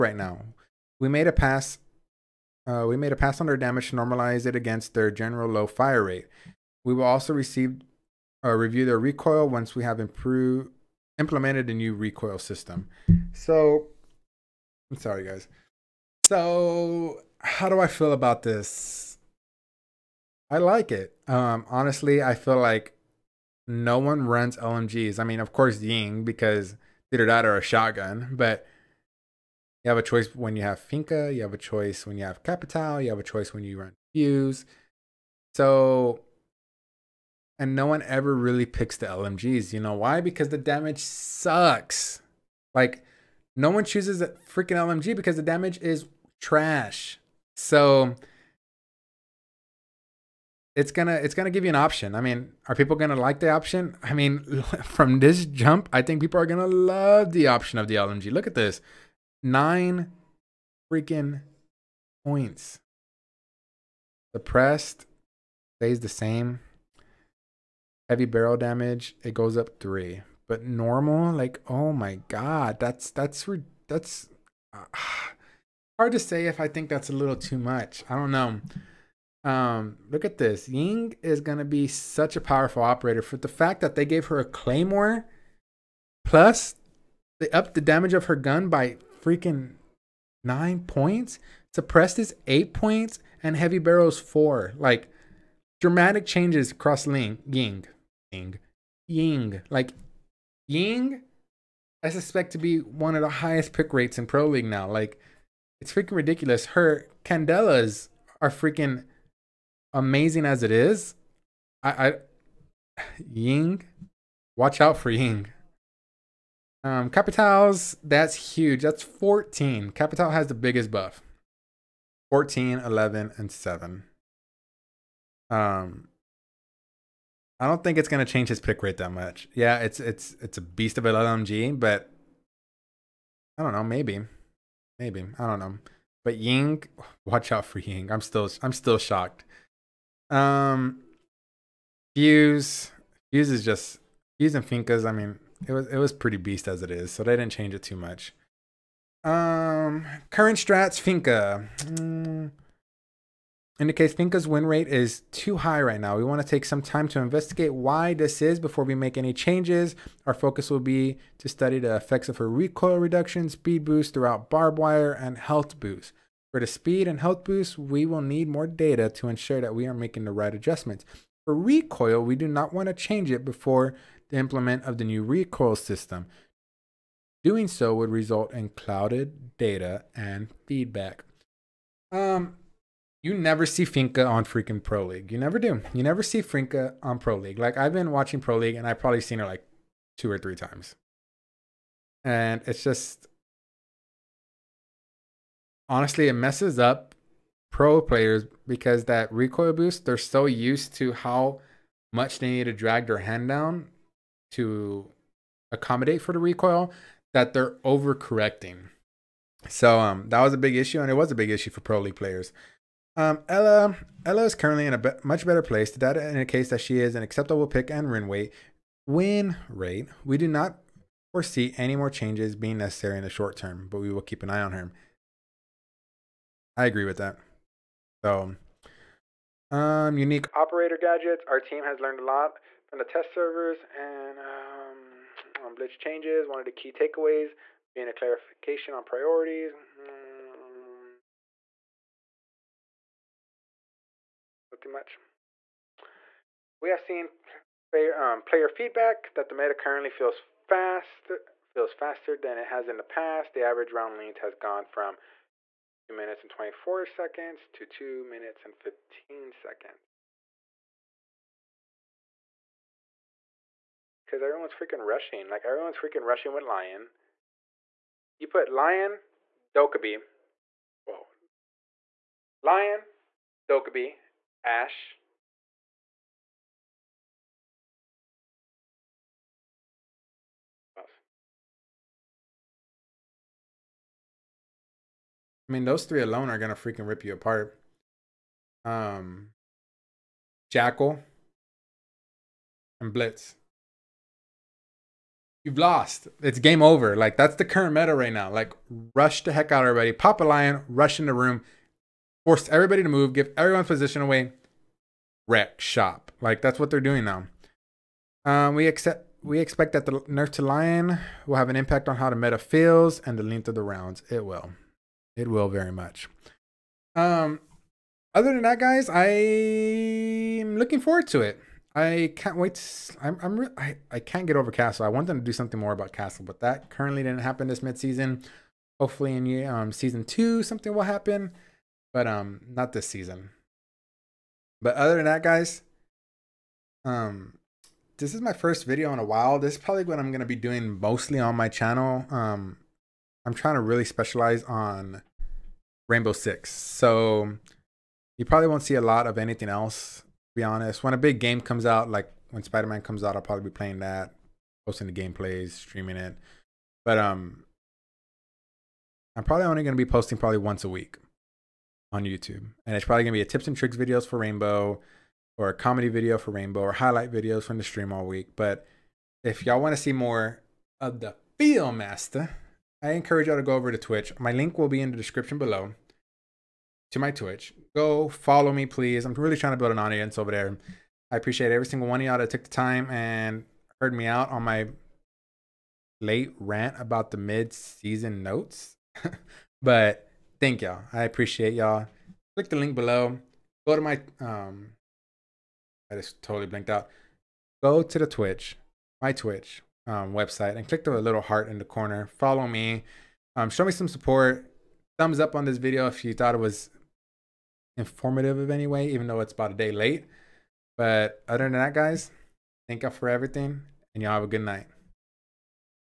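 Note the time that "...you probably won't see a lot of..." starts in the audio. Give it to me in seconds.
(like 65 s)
348 s.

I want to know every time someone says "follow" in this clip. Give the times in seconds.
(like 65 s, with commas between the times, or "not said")
378 s, 402 s.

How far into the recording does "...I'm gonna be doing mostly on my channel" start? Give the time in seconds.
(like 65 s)
340 s.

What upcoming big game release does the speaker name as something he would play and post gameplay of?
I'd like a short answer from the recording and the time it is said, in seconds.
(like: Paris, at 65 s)
Spider-Man, at 352 s.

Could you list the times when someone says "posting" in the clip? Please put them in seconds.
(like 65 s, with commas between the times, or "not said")
354 s, 360 s.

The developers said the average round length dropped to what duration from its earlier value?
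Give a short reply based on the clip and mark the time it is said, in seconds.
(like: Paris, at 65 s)
2 minutes 15 seconds, at 257 s.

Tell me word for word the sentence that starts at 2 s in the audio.
Uh, we made a pass on their damage to normalize it against their general low fire rate.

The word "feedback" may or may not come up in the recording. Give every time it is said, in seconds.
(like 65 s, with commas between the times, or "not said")
180 s, 248 s.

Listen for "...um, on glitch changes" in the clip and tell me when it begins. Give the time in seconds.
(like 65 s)
234 s.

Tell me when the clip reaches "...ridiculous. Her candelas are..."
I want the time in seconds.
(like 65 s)
106 s.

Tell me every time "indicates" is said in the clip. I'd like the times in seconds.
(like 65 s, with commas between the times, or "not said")
153 s, 216 s.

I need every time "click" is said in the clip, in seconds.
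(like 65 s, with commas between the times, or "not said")
392 s, 400 s.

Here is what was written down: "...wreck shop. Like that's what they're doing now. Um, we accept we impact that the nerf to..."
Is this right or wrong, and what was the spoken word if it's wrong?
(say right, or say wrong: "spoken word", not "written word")
wrong: "expect", not "impact".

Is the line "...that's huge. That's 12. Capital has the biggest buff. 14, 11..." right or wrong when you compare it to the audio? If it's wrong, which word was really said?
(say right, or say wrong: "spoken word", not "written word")
wrong: "14", not "12".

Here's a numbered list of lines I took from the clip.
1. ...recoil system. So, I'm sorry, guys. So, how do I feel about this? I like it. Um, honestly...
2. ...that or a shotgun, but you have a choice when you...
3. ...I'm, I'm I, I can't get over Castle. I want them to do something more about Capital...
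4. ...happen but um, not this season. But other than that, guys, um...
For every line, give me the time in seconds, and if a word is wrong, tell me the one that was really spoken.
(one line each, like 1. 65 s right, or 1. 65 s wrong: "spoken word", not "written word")
1. 11 s right
2. 27 s right
3. 323 s wrong: "Castle", not "Capital"
4. 331 s right.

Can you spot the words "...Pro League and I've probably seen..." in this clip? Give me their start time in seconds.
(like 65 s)
188 s.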